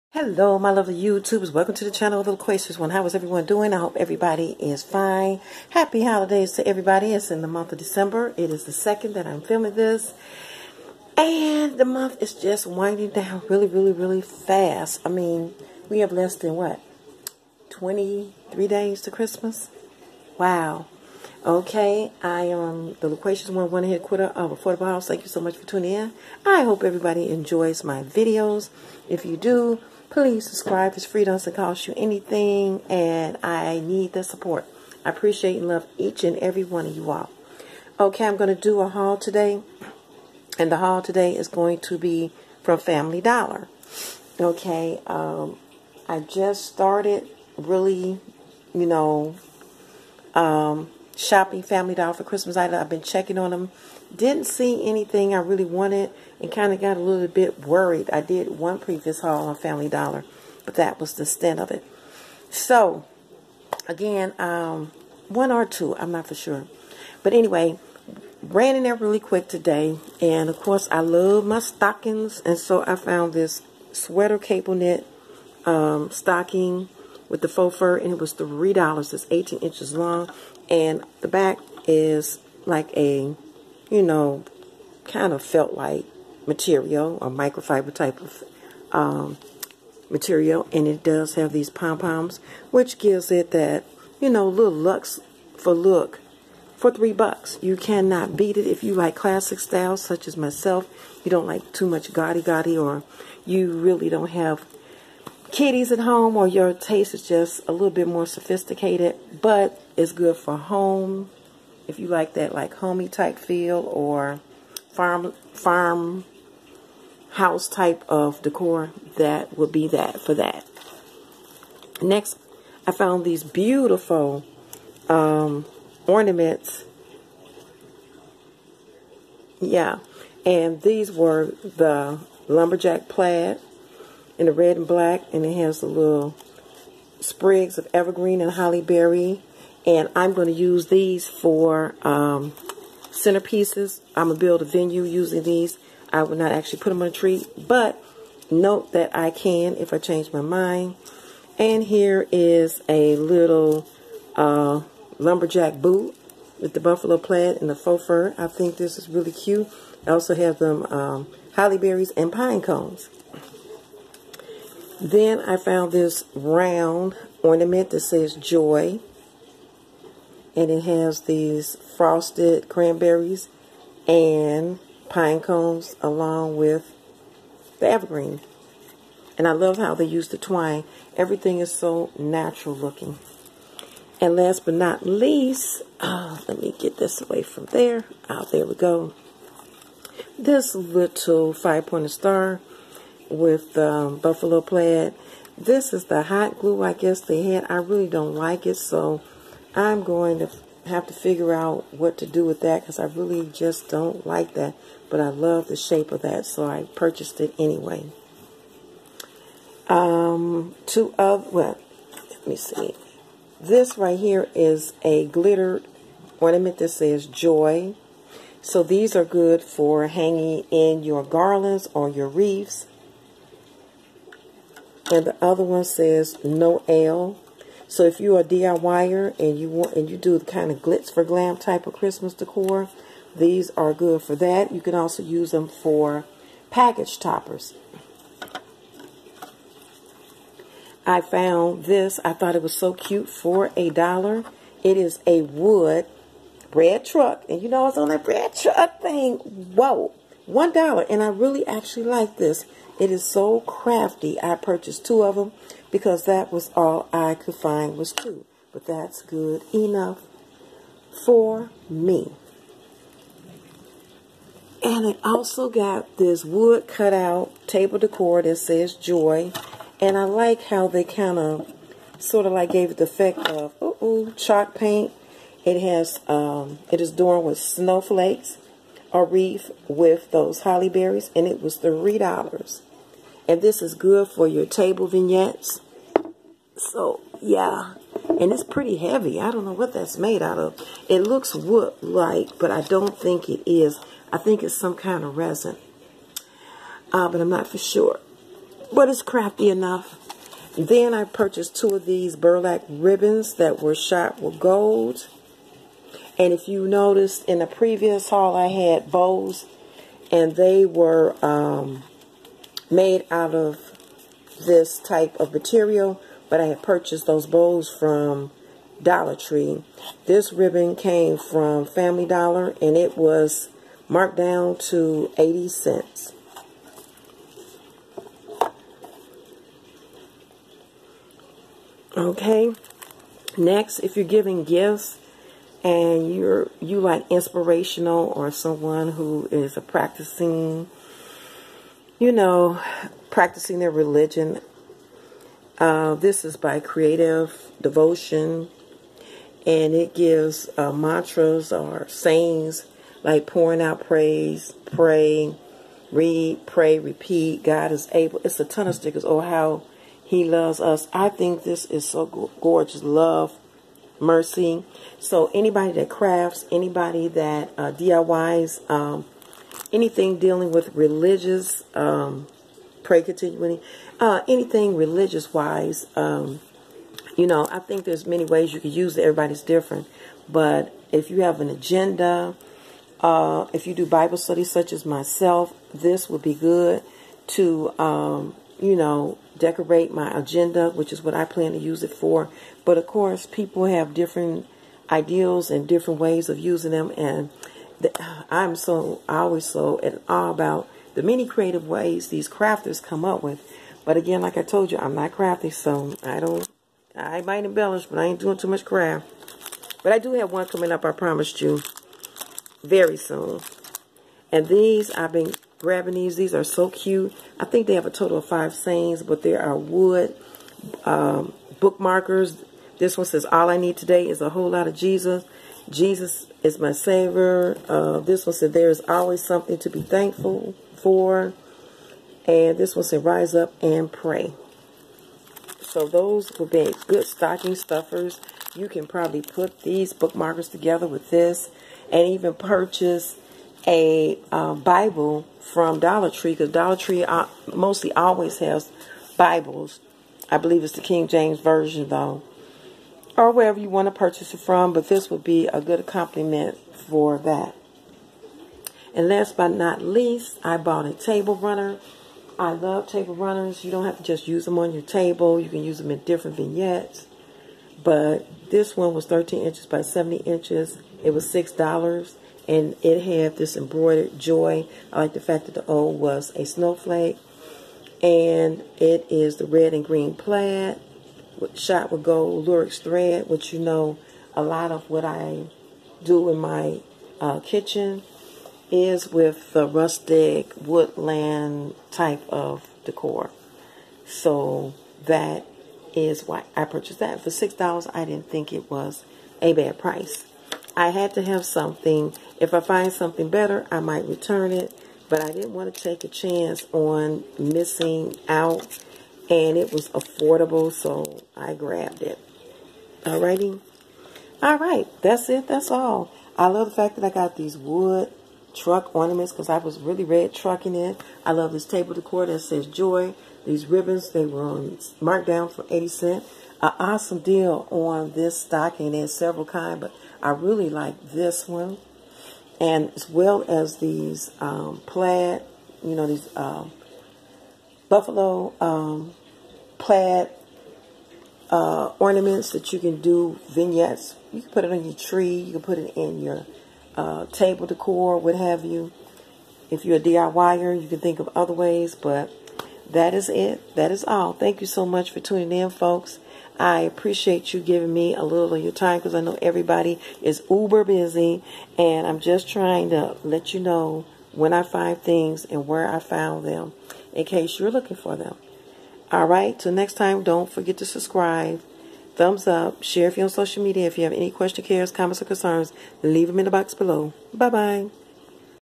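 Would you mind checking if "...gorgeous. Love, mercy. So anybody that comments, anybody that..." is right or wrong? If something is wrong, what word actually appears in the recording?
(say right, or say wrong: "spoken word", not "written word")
wrong: "crafts", not "comments".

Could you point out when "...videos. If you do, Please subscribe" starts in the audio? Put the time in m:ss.
0:28.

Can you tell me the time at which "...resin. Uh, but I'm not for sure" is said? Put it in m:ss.
4:55.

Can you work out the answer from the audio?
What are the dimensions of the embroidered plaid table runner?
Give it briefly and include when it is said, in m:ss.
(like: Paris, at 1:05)
13 by 70 inches, at 7:49.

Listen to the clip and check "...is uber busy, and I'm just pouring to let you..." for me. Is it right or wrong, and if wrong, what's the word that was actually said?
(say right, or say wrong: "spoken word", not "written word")
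wrong: "trying", not "pouring".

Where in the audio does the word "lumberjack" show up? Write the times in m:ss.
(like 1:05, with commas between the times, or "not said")
2:12, 2:35.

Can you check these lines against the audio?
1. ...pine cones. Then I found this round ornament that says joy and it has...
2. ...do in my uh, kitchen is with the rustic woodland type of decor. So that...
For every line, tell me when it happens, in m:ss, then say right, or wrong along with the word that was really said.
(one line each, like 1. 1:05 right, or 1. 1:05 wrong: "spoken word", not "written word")
1. 2:42 right
2. 8:06 right.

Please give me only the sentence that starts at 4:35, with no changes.
It has um, it is adorned with snowflakes, a wreath with those holly berries, and it was three dollars.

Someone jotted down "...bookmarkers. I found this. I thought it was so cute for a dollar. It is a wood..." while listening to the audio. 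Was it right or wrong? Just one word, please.
wrong.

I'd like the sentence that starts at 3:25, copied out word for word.
But I love the shape of that, so I purchased it anyway.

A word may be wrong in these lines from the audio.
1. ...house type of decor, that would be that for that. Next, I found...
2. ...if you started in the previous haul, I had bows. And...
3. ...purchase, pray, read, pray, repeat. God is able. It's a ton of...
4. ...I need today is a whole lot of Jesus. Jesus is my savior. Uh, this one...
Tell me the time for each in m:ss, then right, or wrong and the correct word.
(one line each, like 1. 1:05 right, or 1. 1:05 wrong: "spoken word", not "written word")
1. 1:57 right
2. 5:06 wrong: "noticed", not "started"
3. 5:54 wrong: "praise", not "purchase"
4. 7:03 right.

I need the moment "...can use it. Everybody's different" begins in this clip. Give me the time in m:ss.
6:18.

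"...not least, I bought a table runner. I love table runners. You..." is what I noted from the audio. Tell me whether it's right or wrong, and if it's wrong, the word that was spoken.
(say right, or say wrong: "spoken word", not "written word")
right.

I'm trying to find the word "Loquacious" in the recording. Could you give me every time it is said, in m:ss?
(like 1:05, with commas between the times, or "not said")
0:02, 0:23.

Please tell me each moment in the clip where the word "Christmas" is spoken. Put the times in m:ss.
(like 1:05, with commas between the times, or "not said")
0:19, 0:52, 3:51.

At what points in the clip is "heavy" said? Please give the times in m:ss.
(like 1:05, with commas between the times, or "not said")
4:48.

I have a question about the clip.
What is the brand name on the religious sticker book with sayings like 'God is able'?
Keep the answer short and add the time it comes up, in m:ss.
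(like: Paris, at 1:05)
Creative Devotion, at 5:46.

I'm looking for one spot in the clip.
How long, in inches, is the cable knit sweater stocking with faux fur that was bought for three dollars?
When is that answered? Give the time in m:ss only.
1:19.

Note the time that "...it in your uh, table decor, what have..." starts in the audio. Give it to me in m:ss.
9:05.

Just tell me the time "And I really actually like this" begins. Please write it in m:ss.
4:11.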